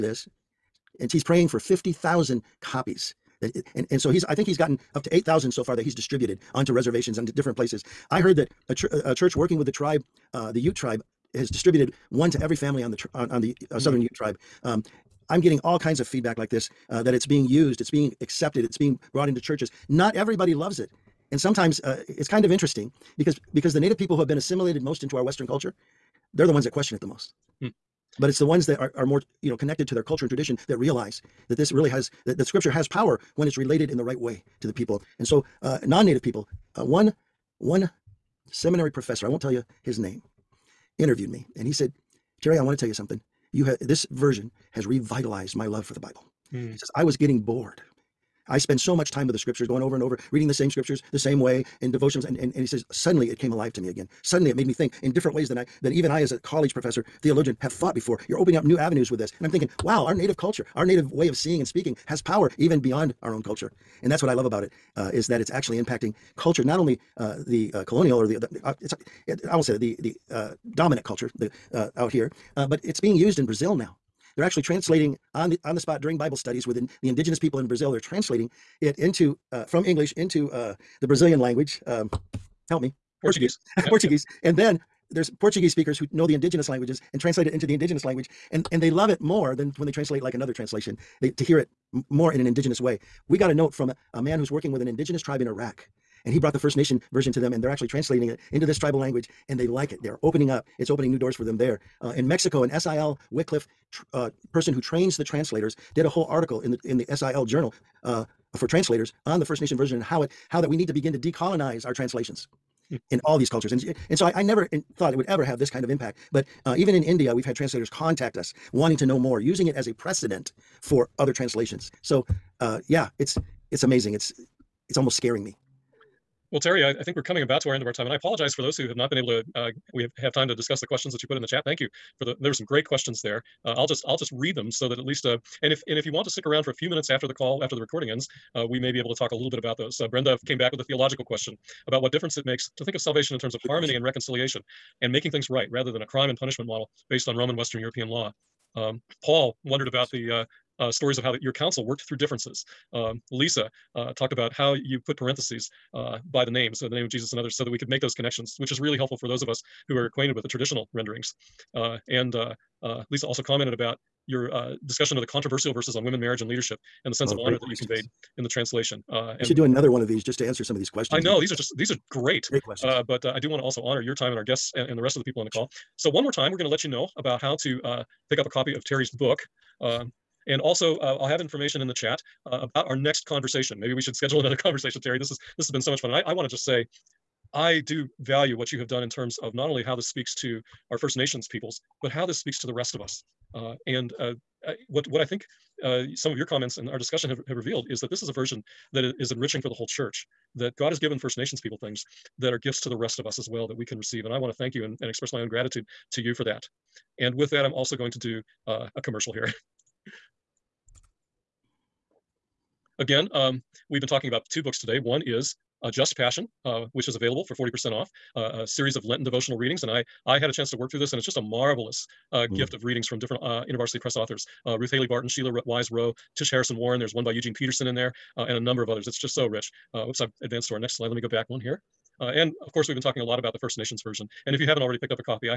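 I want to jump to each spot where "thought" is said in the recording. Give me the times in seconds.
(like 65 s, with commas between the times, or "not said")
57 s, 114 s.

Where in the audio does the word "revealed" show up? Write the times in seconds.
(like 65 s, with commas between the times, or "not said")
197 s.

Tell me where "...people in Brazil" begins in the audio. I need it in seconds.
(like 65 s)
77 s.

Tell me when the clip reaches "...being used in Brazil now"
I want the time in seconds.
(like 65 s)
72 s.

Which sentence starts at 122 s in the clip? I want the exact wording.
So, uh, yeah, it's it's amazing.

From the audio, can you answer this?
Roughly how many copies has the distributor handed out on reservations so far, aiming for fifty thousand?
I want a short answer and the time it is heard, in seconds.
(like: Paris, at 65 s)
8,000, at 5 s.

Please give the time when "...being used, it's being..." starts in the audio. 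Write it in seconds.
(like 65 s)
17 s.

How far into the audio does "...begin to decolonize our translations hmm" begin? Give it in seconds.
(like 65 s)
110 s.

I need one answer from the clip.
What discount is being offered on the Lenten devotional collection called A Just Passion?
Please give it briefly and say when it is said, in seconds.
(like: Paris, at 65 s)
40%, at 217 s.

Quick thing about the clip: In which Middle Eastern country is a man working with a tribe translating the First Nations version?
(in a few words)
Iraq.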